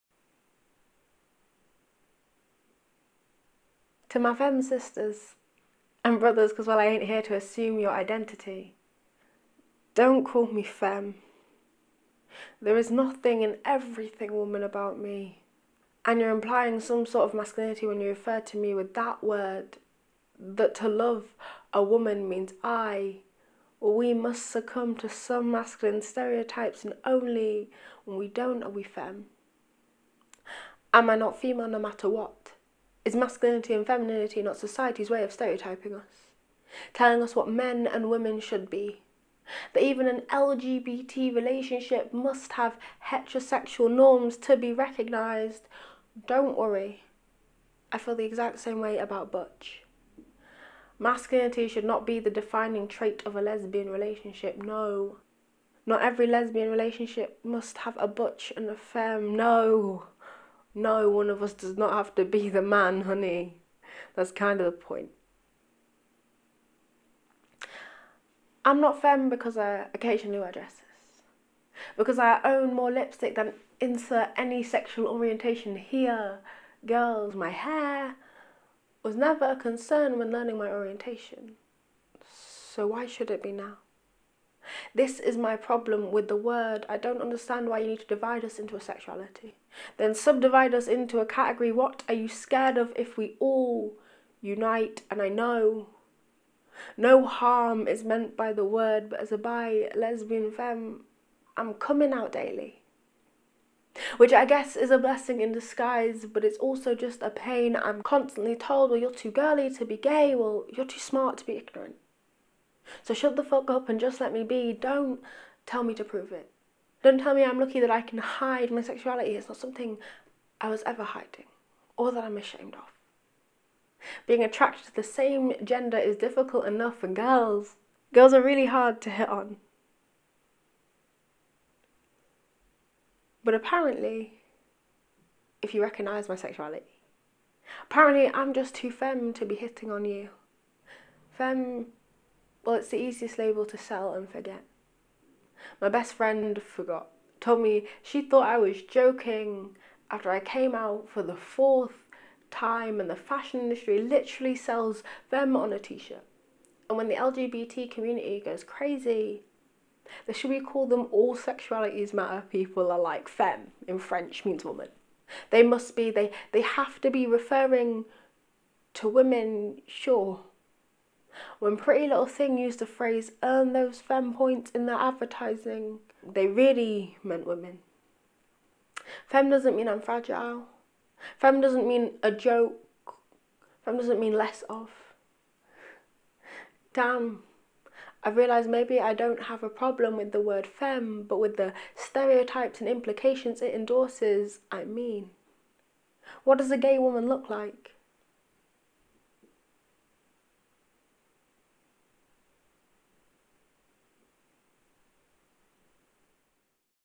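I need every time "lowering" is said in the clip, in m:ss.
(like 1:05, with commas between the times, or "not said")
not said.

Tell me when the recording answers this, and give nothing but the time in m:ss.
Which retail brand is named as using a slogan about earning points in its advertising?
2:51.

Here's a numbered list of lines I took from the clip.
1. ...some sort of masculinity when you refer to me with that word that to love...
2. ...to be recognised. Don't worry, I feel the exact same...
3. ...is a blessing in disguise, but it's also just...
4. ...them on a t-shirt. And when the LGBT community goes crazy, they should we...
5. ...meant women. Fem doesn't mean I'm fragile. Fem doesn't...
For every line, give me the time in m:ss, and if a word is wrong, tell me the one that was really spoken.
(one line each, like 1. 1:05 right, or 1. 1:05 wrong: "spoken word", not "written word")
1. 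0:16 right
2. 0:44 right
3. 1:44 right
4. 2:35 right
5. 2:57 right.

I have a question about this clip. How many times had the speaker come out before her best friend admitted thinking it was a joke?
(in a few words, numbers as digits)
4.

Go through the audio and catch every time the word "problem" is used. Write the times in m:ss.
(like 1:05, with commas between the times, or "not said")
1:25, 3:09.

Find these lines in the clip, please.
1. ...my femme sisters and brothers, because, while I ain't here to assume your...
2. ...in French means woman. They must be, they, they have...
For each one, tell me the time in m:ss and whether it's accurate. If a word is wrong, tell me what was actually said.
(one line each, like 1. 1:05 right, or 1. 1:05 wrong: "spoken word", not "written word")
1. 0:04 right
2. 2:43 right.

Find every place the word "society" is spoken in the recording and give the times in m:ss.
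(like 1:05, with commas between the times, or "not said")
0:34.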